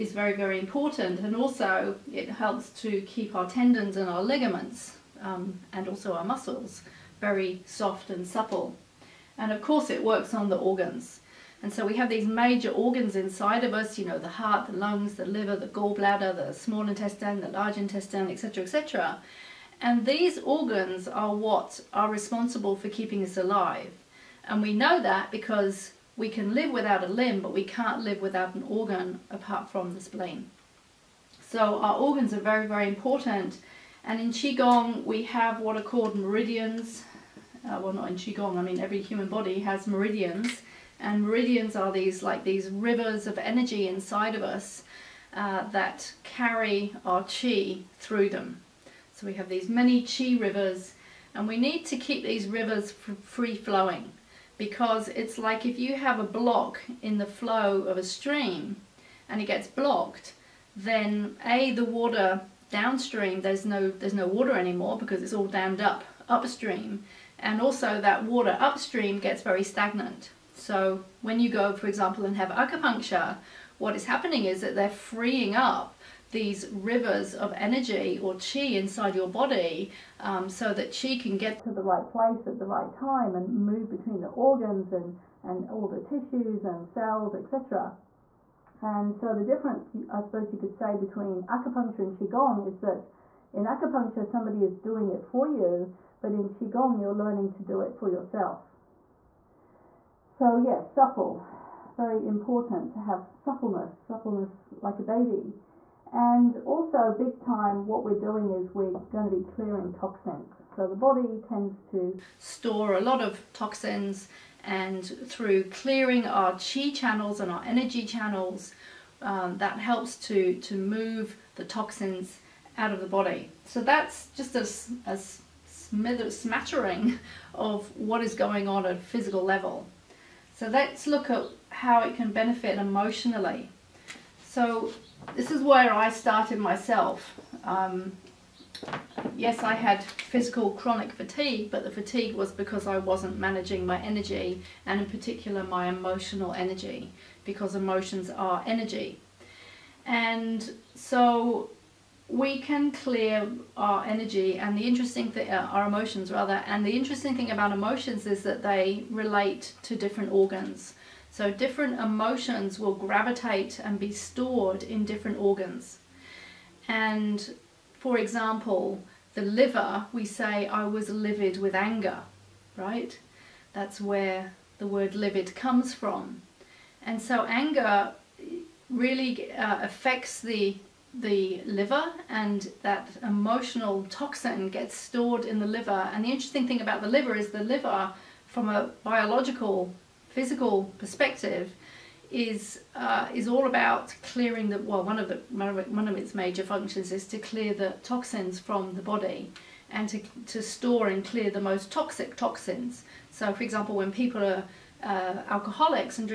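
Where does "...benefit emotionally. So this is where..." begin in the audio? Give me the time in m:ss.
2:12.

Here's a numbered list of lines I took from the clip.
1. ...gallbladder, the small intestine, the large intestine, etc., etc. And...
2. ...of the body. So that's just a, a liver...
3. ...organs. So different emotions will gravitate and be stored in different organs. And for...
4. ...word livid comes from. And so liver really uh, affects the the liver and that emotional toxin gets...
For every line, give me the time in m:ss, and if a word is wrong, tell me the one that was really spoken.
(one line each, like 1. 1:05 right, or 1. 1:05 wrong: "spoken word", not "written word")
1. 0:15 right
2. 2:02 wrong: "smither", not "liver"
3. 2:40 right
4. 2:54 wrong: "anger", not "liver".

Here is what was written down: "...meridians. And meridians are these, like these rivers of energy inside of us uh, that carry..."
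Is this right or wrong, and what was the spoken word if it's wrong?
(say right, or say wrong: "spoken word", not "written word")
right.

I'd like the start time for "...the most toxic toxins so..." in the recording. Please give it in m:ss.
3:21.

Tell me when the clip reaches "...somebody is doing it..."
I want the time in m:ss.
1:34.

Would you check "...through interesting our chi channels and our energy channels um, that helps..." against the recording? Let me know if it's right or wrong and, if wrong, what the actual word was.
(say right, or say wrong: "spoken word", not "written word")
wrong: "clearing", not "interesting".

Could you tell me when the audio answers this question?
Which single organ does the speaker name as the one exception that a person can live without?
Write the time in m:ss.
0:30.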